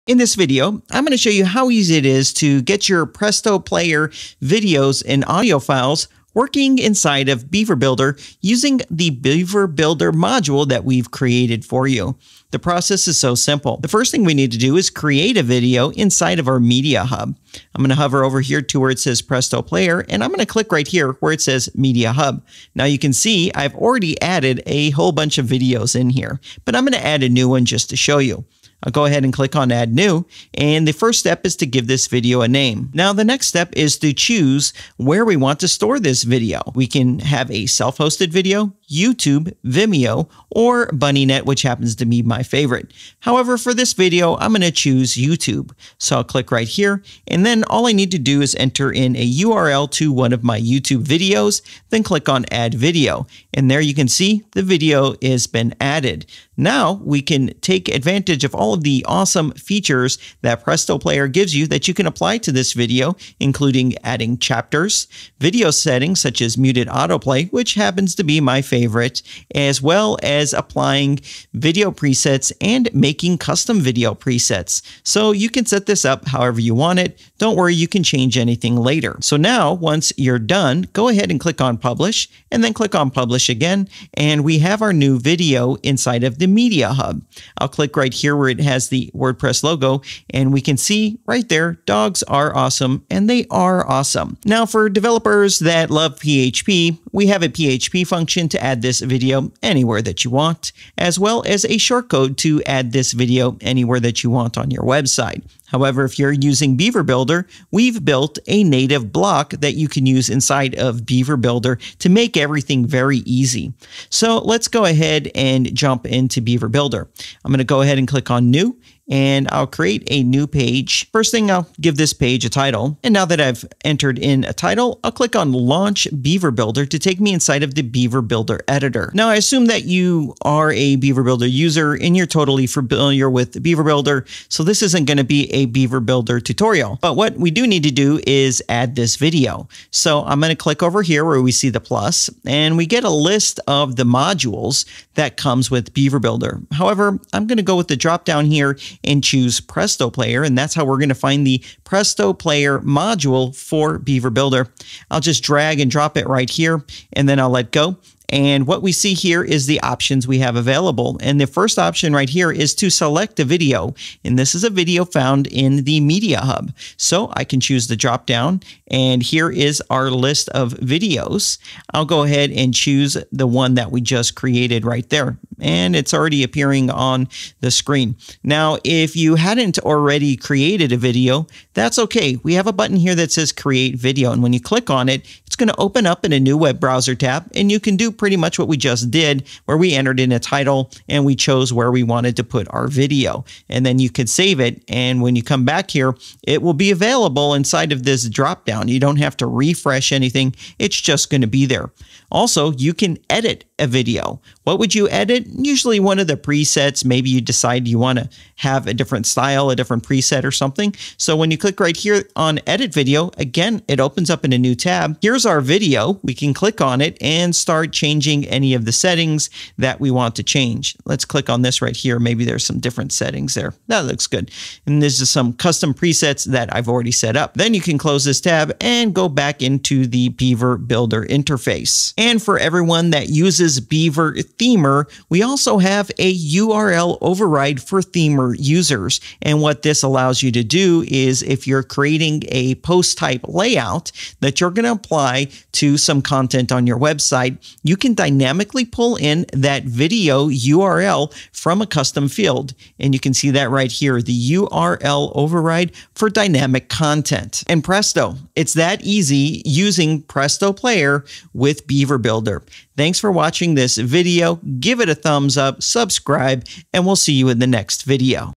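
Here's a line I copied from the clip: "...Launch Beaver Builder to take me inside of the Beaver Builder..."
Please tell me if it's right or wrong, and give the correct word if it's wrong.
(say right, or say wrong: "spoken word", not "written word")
right.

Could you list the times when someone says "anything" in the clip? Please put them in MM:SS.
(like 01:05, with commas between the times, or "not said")
01:18, 03:20.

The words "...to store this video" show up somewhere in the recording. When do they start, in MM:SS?
00:35.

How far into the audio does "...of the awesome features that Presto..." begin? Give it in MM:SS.
00:58.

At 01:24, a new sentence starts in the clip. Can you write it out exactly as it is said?
And we have our new video inside of the media hub.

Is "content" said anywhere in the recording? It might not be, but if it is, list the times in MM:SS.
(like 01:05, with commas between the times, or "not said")
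04:06, 04:16.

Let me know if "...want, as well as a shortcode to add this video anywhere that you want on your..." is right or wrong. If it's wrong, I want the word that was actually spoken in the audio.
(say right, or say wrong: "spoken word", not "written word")
right.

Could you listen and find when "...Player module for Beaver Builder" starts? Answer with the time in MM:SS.
02:32.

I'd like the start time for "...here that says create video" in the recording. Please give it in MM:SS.
03:02.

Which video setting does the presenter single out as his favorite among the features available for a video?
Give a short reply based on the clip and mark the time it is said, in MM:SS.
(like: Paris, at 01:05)
muted autoplay, at 01:06.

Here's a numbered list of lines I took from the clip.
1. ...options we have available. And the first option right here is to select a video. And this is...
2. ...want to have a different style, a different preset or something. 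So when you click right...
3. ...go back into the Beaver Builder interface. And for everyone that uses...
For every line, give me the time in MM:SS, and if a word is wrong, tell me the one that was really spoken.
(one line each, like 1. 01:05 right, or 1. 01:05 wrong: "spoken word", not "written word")
1. 02:39 right
2. 03:27 right
3. 03:49 right.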